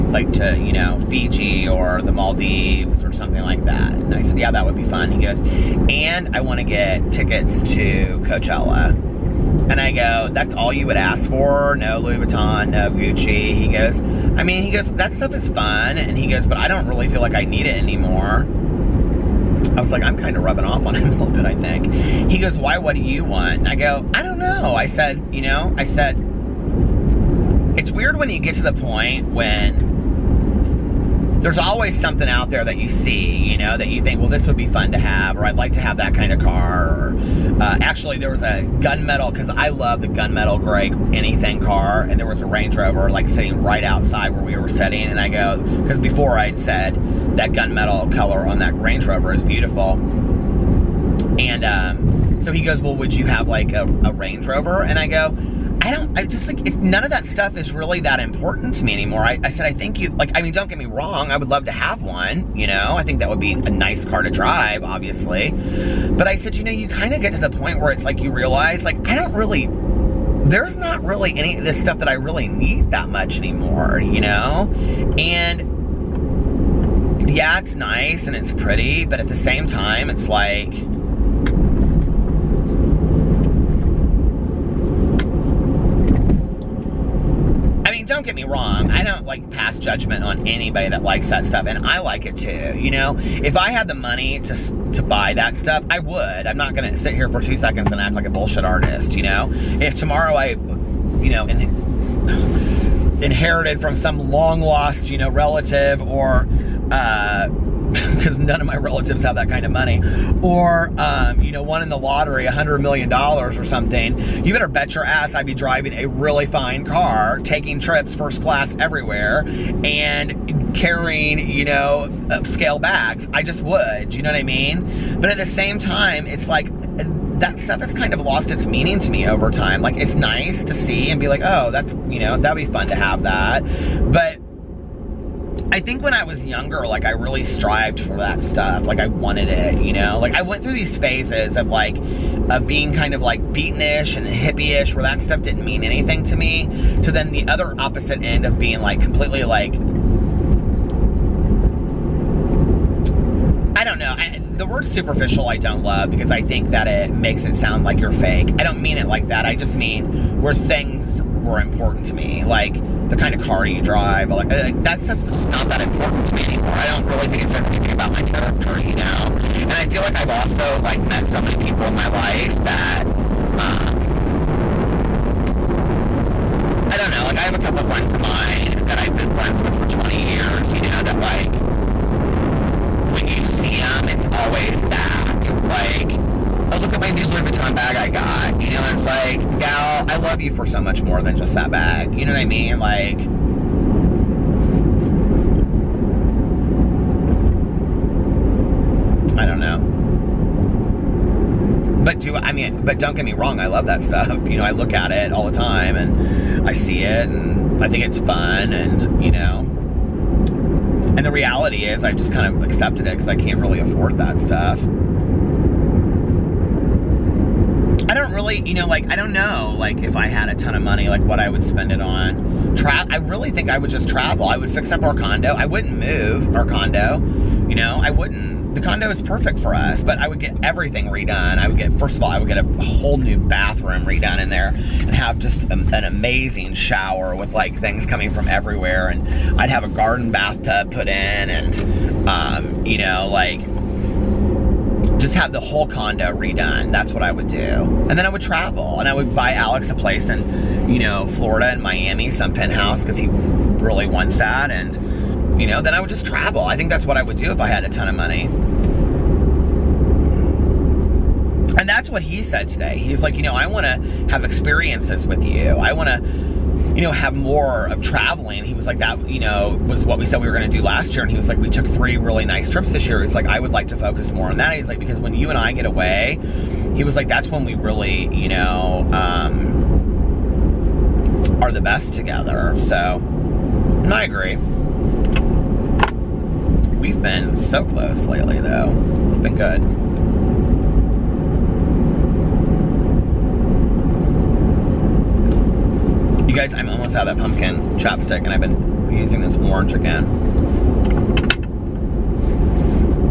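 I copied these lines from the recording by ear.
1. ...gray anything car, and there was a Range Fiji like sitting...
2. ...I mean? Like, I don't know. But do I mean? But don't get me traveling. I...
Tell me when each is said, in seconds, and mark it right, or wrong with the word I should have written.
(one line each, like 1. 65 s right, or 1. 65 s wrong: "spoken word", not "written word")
1. 40 s wrong: "Rover", not "Fiji"
2. 192 s wrong: "wrong", not "traveling".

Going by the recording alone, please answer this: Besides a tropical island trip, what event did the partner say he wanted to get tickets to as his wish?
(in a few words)
Coachella.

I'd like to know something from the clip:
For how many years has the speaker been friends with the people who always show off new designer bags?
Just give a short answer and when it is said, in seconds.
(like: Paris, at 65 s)
20, at 179 s.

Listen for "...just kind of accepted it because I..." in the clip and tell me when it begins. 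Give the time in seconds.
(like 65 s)
212 s.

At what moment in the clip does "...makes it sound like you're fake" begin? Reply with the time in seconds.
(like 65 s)
157 s.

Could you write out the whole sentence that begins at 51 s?
And um, so he goes, well, would you have like a, a Range Rover?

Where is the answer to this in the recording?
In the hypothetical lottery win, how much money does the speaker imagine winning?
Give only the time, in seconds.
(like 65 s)
112 s.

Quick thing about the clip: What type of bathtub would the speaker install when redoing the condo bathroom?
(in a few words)
Garden bathtub.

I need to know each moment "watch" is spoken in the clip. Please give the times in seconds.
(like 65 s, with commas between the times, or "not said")
not said.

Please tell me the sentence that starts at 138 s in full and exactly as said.
Like I wanted it, you know.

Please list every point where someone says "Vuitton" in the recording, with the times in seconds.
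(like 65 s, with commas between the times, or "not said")
12 s, 187 s.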